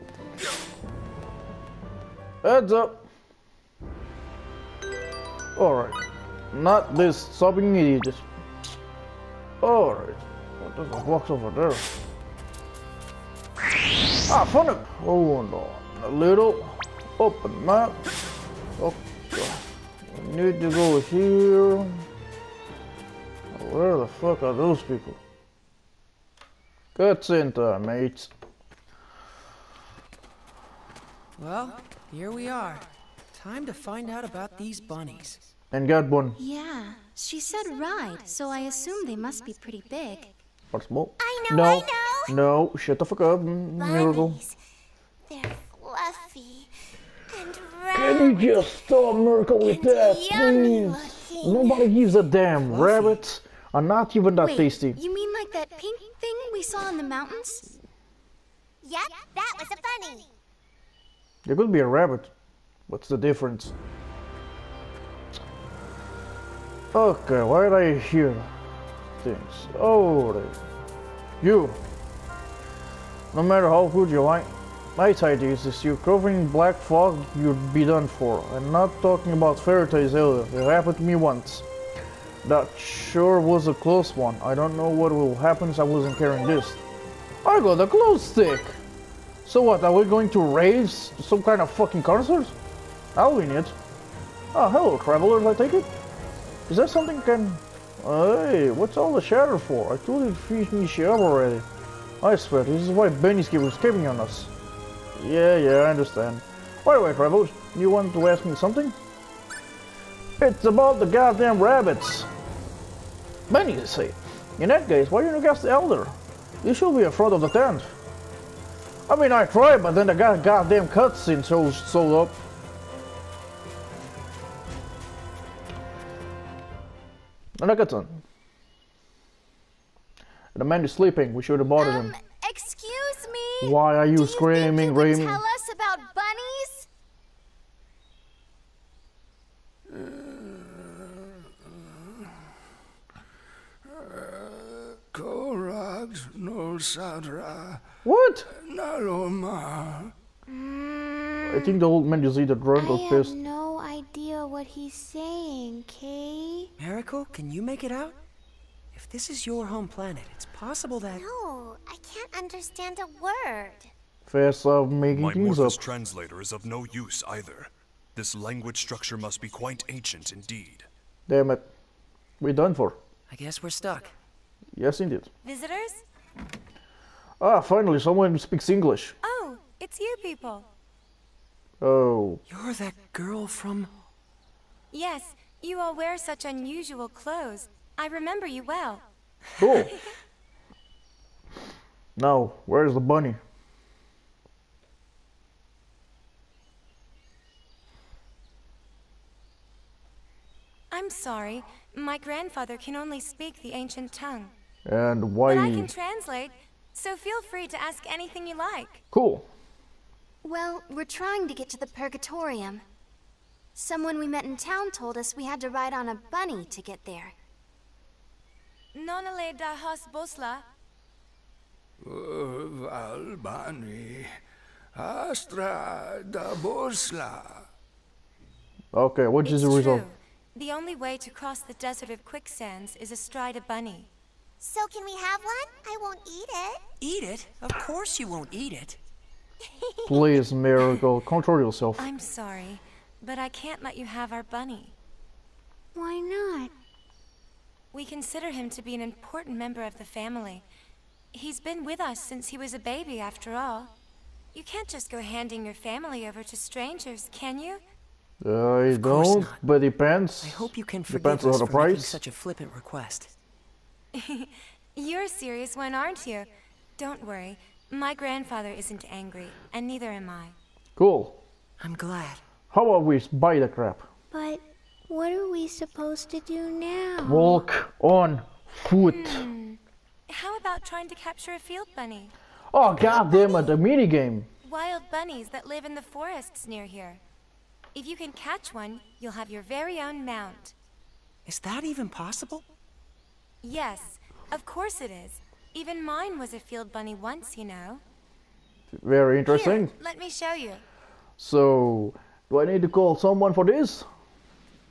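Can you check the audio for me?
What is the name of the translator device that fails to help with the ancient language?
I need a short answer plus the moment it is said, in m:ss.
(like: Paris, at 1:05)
Morphus translator, at 2:45.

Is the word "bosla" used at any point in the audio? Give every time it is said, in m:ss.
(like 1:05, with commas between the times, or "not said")
3:40, 3:46.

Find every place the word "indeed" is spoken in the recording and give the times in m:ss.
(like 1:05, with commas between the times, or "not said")
2:50, 2:54.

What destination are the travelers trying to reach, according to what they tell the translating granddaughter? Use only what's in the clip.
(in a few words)
The Purgatorium.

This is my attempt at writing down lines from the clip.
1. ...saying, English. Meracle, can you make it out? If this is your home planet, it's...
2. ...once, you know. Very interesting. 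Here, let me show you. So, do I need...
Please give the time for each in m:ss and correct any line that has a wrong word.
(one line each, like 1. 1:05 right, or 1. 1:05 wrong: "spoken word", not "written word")
1. 2:34 wrong: "Kate", not "English"
2. 4:57 right.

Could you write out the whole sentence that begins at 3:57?
Of course you won't eat it.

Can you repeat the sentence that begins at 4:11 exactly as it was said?
He's been with us since he was a baby, after all.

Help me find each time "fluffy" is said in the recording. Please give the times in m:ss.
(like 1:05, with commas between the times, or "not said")
0:45, 0:52.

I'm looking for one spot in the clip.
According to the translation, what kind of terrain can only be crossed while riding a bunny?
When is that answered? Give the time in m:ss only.
3:51.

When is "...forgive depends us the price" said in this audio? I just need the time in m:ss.
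4:21.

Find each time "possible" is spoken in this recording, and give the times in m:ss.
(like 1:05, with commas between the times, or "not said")
2:40, 4:52.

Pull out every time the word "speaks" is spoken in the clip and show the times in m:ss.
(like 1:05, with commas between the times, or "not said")
2:58, 3:23.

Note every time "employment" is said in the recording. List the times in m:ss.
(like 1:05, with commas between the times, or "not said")
not said.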